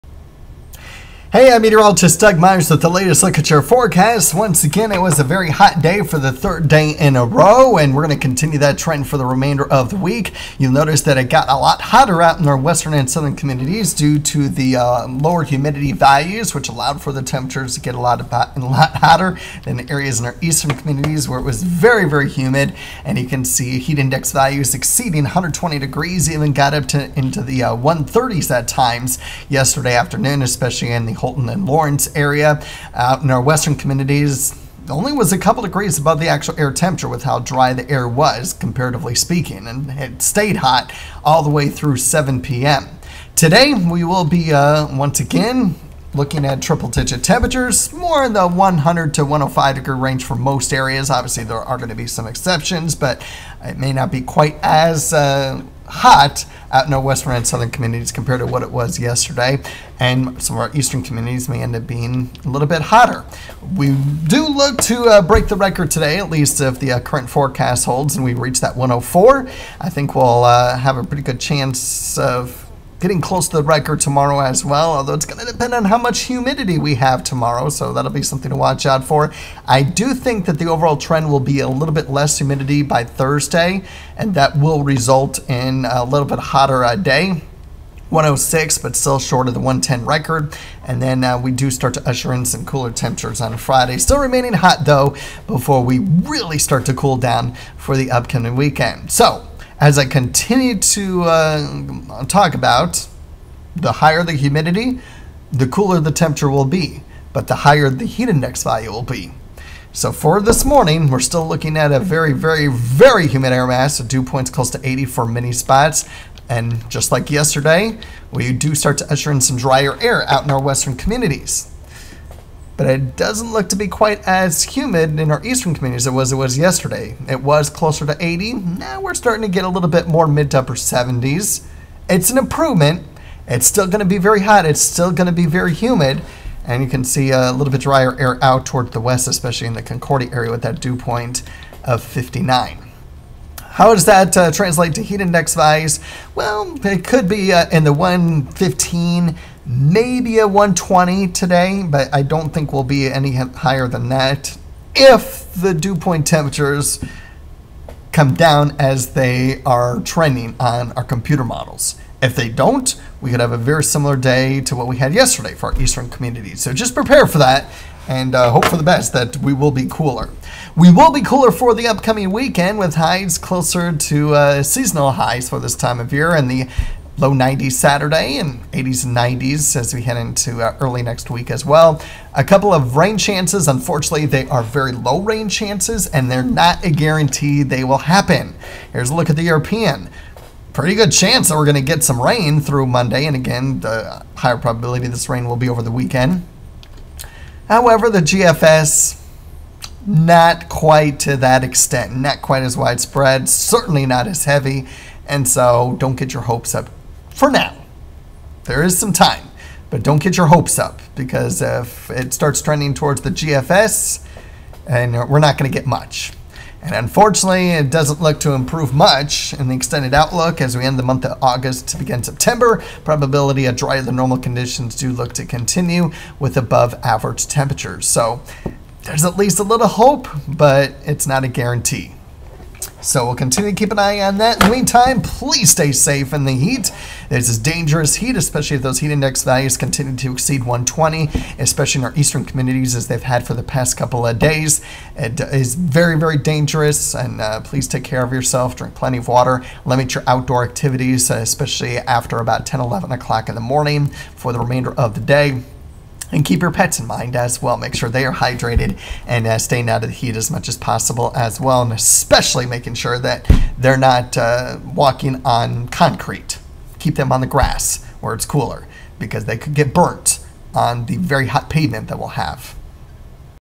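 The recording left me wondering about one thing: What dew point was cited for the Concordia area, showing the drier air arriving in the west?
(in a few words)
59.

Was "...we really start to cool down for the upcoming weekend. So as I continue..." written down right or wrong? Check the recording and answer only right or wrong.
right.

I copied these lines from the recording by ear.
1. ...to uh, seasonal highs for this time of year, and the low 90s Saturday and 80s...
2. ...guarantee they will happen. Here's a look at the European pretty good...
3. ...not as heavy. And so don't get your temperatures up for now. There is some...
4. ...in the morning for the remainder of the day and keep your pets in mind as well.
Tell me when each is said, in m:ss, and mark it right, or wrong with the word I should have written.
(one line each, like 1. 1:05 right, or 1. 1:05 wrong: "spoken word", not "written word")
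1. 2:53 right
2. 3:06 right
3. 3:24 wrong: "hopes", not "temperatures"
4. 4:13 right.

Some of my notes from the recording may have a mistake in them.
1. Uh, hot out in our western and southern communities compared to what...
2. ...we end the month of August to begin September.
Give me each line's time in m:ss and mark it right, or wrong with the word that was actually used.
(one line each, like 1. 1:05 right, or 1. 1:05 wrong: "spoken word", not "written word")
1. 0:55 right
2. 3:40 right.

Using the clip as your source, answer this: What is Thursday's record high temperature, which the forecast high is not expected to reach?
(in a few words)
110.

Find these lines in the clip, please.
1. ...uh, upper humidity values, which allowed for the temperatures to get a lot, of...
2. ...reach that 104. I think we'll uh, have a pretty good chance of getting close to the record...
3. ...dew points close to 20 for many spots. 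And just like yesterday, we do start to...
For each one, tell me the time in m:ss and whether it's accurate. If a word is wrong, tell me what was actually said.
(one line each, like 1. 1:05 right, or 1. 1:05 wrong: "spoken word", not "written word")
1. 0:14 wrong: "lower", not "upper"
2. 1:08 right
3. 1:54 wrong: "80", not "20".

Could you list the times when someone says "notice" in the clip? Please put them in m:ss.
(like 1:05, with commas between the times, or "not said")
0:10.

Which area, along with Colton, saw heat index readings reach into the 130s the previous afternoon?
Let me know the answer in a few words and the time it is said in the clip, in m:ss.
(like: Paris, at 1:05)
Lawrence, at 0:31.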